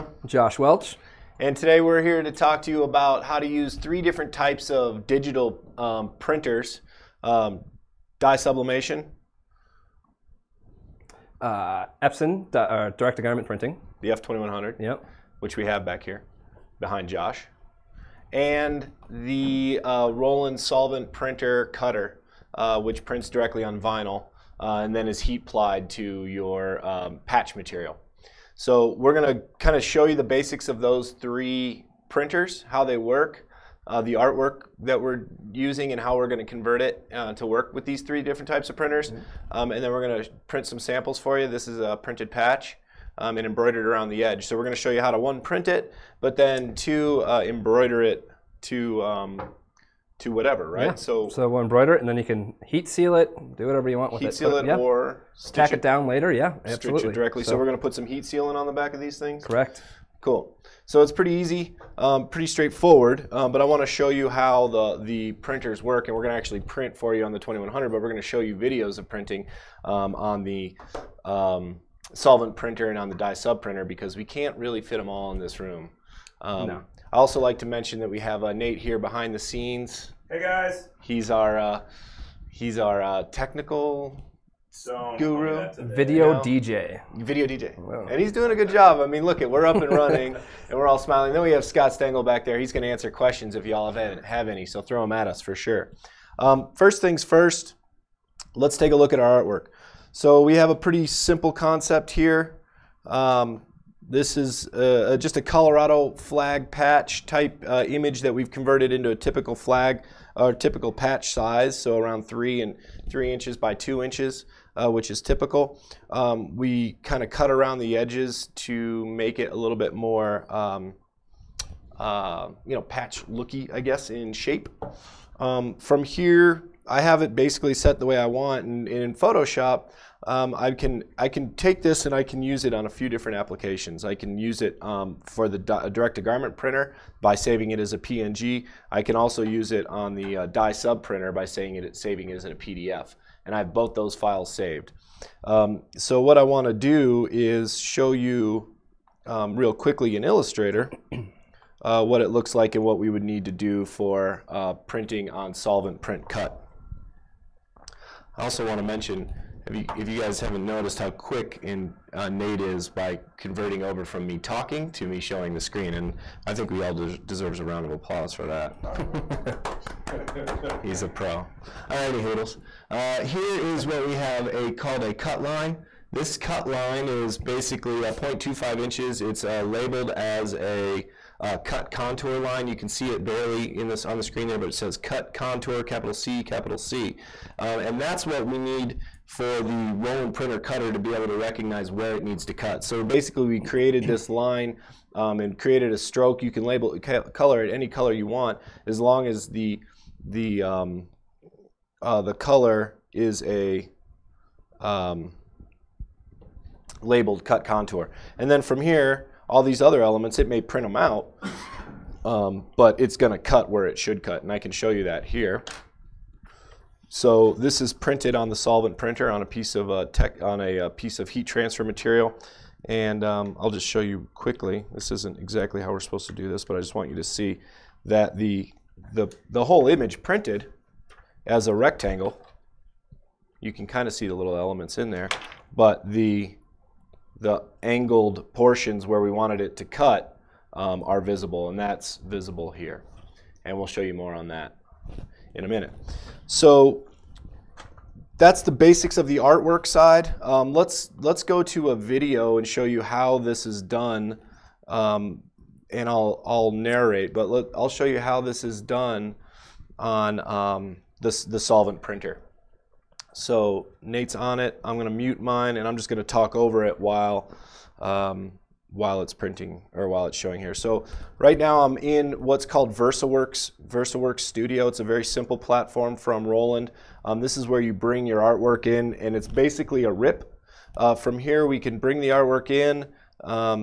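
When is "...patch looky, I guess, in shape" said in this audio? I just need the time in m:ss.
2:02.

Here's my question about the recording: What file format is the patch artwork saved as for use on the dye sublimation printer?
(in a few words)
PDF.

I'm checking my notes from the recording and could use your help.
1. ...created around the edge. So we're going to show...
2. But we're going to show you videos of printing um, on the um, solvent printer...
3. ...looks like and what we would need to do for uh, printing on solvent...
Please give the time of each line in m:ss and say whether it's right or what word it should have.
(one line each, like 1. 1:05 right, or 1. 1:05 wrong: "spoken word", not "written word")
1. 0:43 wrong: "embroidered", not "created"
2. 1:07 right
3. 2:32 right.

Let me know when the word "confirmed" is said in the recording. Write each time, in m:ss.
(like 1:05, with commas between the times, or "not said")
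not said.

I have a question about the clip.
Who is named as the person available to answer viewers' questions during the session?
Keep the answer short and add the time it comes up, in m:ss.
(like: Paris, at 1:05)
Scott Stengel, at 1:31.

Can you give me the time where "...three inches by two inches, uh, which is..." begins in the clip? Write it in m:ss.
1:53.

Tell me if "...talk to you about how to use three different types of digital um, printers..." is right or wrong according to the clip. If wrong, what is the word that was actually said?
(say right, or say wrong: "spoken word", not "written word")
right.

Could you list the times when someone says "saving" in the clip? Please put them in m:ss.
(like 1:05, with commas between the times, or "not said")
2:17, 2:21.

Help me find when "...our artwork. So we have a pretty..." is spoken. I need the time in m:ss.
1:39.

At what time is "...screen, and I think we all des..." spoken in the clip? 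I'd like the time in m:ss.
2:45.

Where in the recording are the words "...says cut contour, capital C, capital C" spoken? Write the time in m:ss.
3:04.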